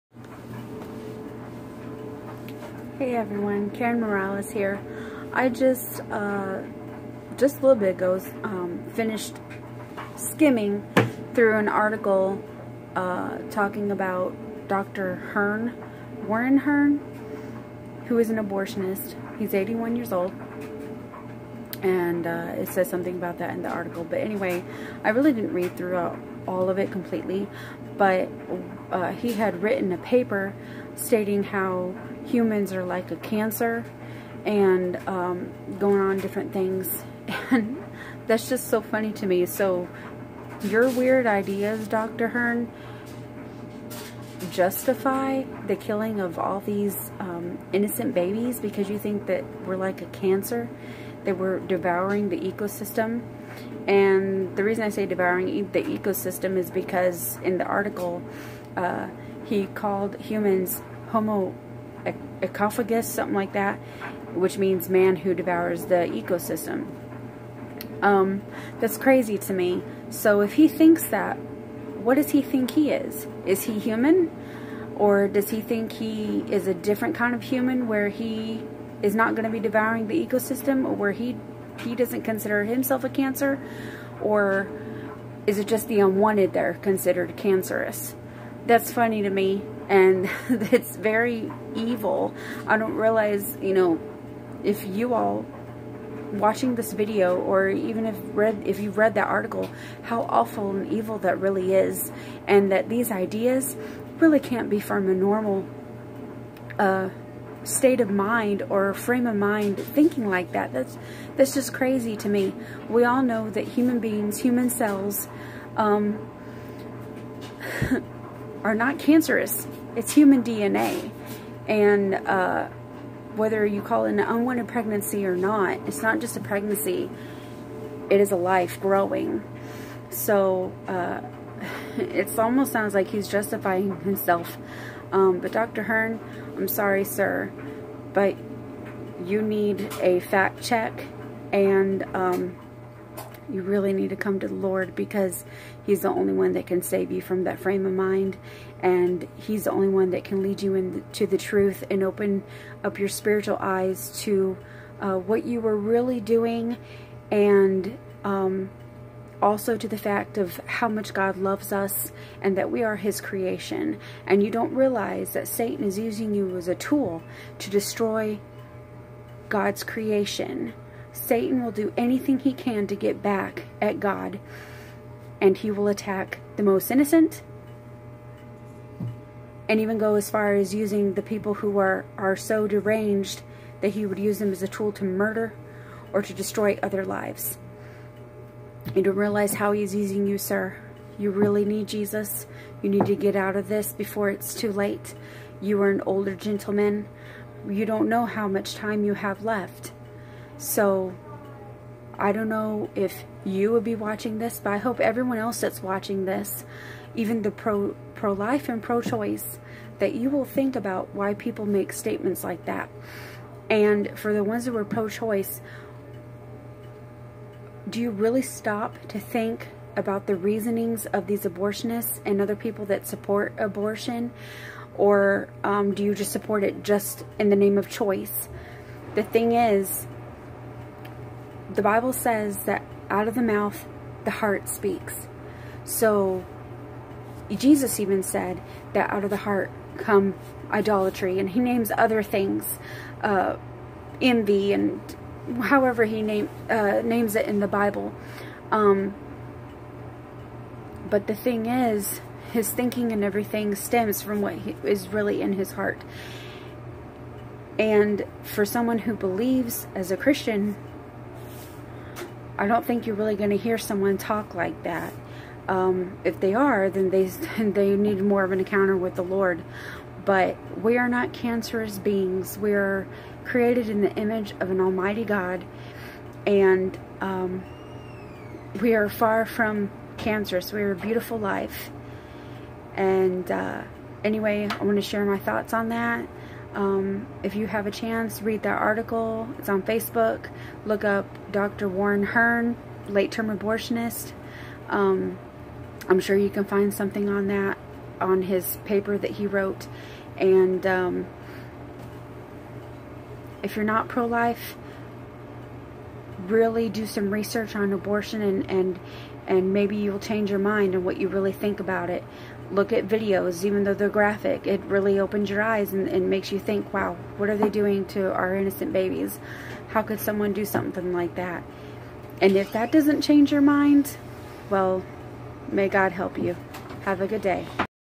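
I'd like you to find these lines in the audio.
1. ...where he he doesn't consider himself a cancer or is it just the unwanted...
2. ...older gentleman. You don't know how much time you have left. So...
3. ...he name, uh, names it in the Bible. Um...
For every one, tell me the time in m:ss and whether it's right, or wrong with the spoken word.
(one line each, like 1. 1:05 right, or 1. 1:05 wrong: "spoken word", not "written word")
1. 1:20 right
2. 3:16 right
3. 4:06 right.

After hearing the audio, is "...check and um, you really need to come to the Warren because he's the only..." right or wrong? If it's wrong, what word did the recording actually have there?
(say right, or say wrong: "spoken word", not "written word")
wrong: "Lord", not "Warren".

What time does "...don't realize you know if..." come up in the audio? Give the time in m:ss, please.
1:32.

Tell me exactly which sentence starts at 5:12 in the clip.
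Look at videos, even though they're graphic.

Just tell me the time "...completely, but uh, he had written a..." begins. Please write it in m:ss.
0:26.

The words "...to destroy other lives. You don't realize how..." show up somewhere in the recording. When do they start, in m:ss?
3:06.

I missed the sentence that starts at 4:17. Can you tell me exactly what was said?
And for someone who believes as a Christian, I don't think you're really going to hear someone talk like that.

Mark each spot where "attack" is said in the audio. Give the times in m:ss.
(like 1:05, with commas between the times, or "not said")
2:55.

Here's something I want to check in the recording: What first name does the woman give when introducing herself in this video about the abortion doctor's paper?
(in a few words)
Karen.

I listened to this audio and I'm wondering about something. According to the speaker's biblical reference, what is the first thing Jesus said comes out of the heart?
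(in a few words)
Idolatry.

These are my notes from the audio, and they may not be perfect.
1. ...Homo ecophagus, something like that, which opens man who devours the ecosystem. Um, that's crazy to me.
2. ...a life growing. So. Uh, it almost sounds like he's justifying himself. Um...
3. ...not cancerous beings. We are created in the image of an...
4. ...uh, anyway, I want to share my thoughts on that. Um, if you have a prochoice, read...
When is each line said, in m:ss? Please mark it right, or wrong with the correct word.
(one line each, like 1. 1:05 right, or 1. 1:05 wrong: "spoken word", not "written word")
1. 1:01 wrong: "means", not "opens"
2. 2:08 right
3. 4:31 right
4. 4:43 wrong: "chance", not "prochoice".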